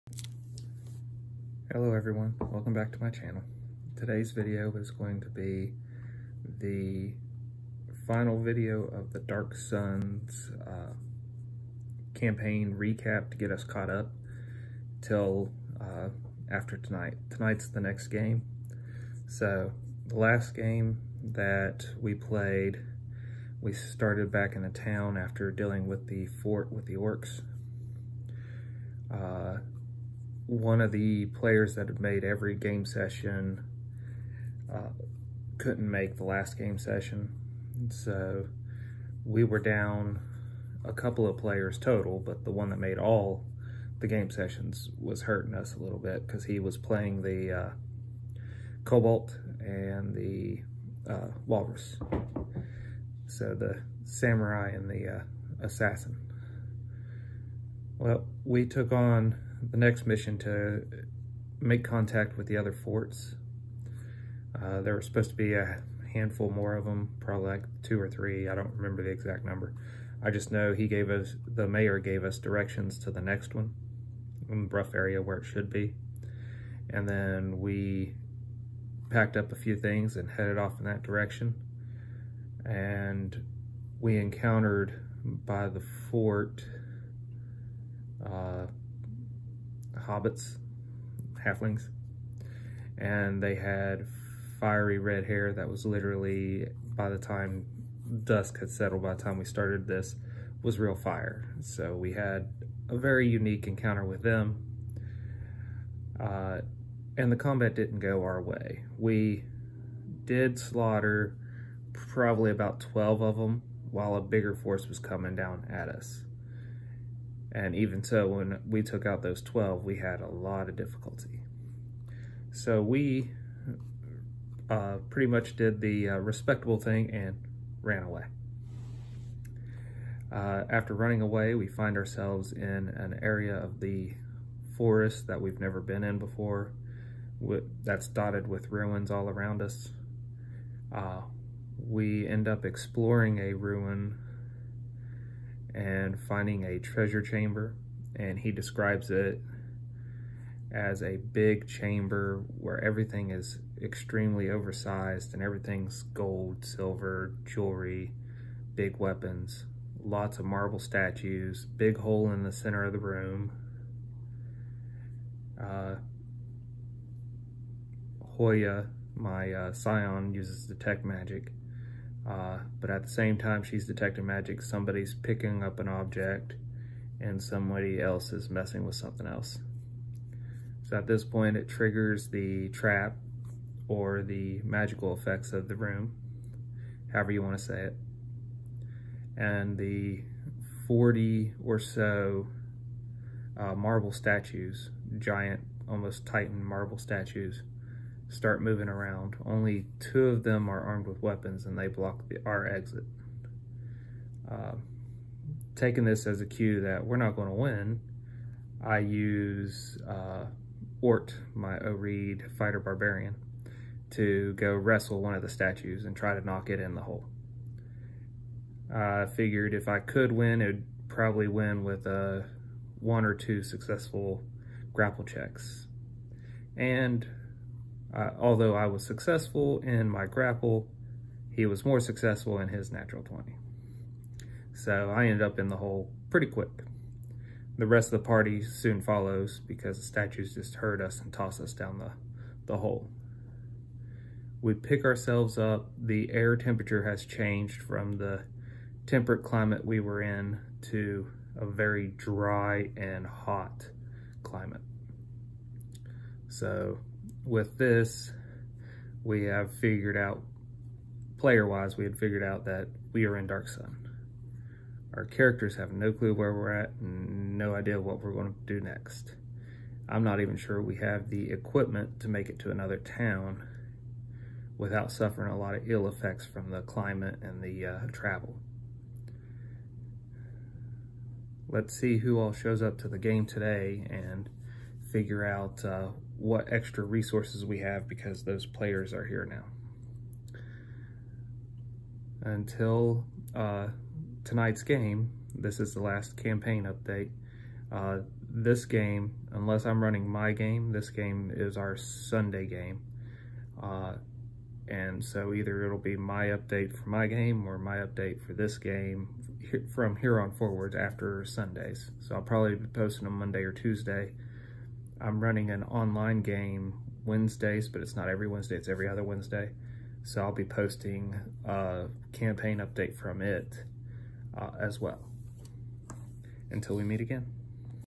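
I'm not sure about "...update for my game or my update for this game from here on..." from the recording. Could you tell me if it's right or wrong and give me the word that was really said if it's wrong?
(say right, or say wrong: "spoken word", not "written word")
right.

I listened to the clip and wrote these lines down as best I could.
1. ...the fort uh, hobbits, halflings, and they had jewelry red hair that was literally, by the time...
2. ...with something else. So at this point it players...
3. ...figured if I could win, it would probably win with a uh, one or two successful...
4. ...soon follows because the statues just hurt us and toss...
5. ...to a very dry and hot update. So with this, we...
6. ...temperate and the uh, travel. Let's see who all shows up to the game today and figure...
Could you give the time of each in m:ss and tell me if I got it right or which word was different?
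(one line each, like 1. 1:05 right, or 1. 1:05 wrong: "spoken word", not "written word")
1. 1:25 wrong: "fiery", not "jewelry"
2. 2:58 wrong: "triggers", not "players"
3. 3:39 right
4. 3:58 right
5. 4:10 wrong: "climate", not "update"
6. 4:36 wrong: "climate", not "temperate".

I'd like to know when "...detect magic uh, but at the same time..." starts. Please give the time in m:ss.
2:50.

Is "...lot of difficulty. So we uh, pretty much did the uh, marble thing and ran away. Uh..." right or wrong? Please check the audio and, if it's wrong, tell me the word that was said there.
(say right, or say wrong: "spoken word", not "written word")
wrong: "respectable", not "marble".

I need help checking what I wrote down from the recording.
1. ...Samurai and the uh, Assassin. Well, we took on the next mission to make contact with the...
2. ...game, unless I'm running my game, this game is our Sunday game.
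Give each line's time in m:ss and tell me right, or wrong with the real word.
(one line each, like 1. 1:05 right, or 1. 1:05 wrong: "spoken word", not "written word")
1. 0:54 right
2. 4:58 right.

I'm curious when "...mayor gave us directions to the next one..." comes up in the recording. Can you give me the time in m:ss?
1:11.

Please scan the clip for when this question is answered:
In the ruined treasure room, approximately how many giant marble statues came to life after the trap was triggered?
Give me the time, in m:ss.
3:10.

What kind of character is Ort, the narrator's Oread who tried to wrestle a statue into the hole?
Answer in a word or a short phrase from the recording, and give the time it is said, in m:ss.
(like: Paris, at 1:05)
fighter barbarian, at 3:32.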